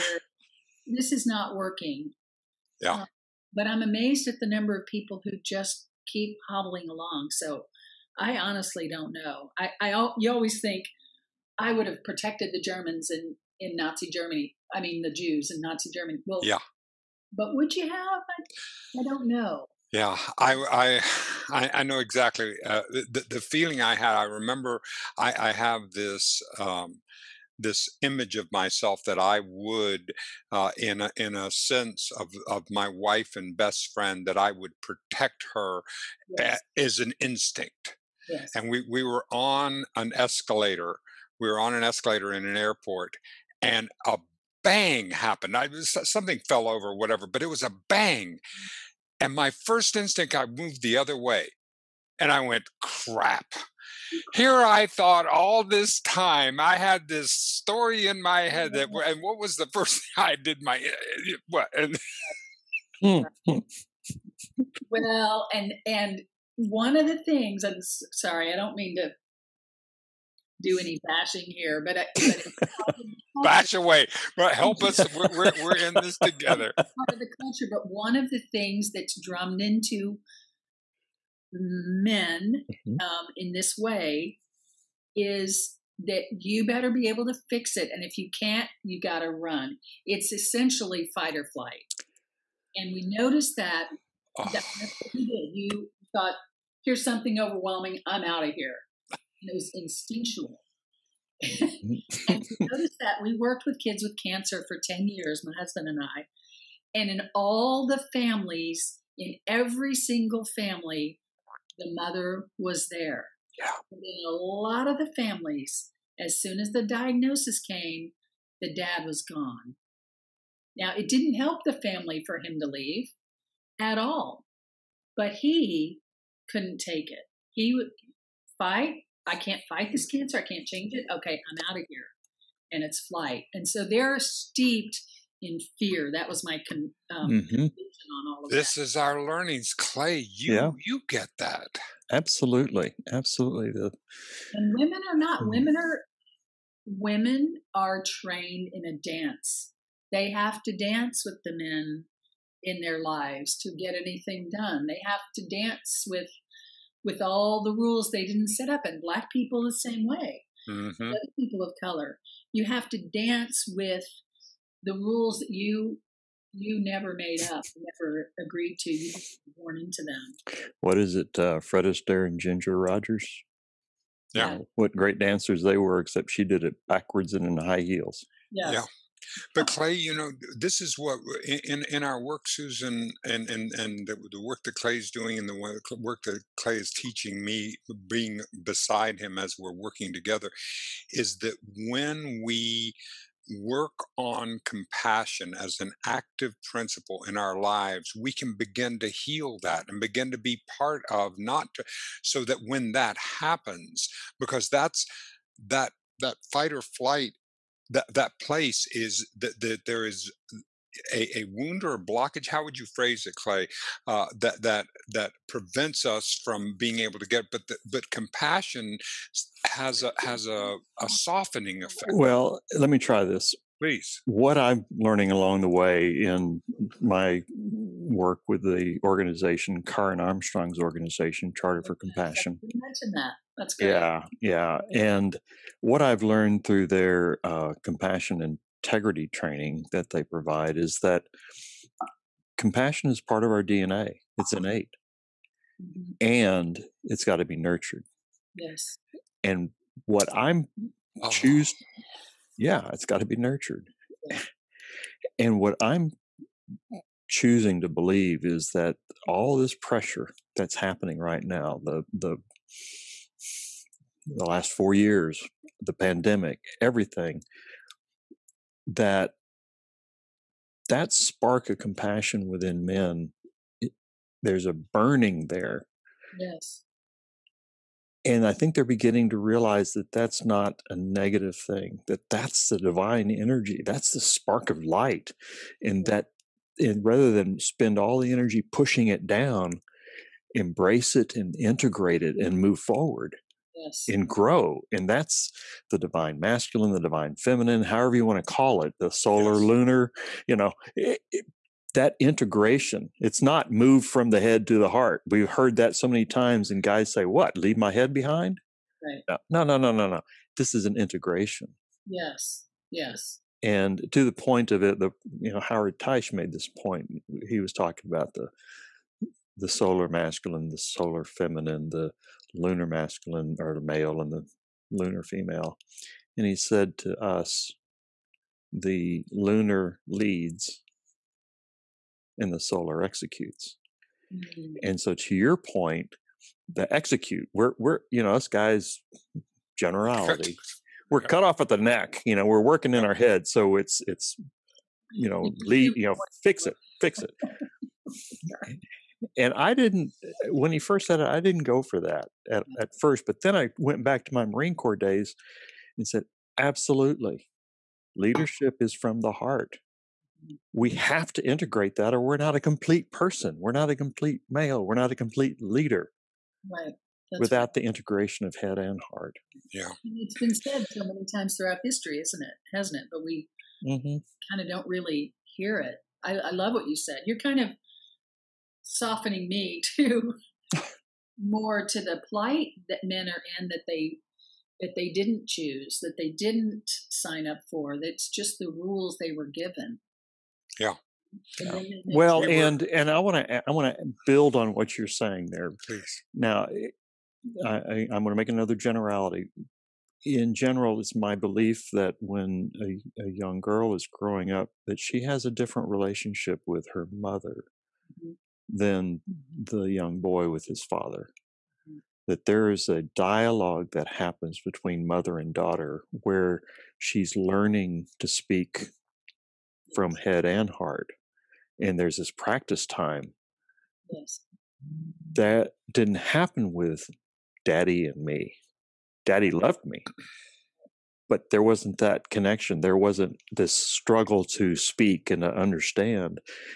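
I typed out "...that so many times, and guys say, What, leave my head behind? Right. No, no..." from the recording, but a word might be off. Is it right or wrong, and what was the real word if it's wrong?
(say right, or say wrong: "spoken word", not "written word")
right.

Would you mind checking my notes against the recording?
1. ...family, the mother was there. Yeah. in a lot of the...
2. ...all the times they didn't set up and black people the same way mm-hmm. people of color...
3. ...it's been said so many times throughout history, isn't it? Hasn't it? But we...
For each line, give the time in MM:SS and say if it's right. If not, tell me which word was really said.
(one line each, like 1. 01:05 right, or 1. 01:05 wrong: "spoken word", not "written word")
1. 01:50 right
2. 02:37 wrong: "rules", not "times"
3. 06:10 right.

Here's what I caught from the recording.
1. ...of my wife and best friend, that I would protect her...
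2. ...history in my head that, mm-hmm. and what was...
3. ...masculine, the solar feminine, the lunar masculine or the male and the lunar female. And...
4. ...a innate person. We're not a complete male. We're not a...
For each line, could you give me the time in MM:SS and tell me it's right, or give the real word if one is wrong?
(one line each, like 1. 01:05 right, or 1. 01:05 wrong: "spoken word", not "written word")
1. 00:32 right
2. 00:57 wrong: "story", not "history"
3. 05:20 right
4. 06:02 wrong: "complete", not "innate".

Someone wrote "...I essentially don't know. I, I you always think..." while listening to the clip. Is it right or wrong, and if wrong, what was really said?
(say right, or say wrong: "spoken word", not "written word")
wrong: "honestly", not "essentially".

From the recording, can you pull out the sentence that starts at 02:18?
is our learnings clay you yeah.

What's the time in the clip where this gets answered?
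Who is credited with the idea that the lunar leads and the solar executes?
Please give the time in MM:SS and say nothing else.
05:15.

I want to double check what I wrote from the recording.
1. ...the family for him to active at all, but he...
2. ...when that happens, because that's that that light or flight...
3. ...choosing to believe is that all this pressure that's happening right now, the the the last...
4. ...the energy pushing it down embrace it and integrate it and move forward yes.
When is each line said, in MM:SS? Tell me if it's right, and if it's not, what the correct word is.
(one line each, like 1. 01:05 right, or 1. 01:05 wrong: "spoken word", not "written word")
1. 02:01 wrong: "leave", not "active"
2. 03:22 wrong: "fight", not "light"
3. 04:17 right
4. 04:48 right.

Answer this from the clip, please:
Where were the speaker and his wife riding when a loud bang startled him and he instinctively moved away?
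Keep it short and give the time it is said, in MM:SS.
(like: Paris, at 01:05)
An escalator in an airport, at 00:41.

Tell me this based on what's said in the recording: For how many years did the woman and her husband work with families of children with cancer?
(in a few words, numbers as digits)
10 years.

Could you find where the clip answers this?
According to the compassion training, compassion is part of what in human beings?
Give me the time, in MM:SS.
04:03.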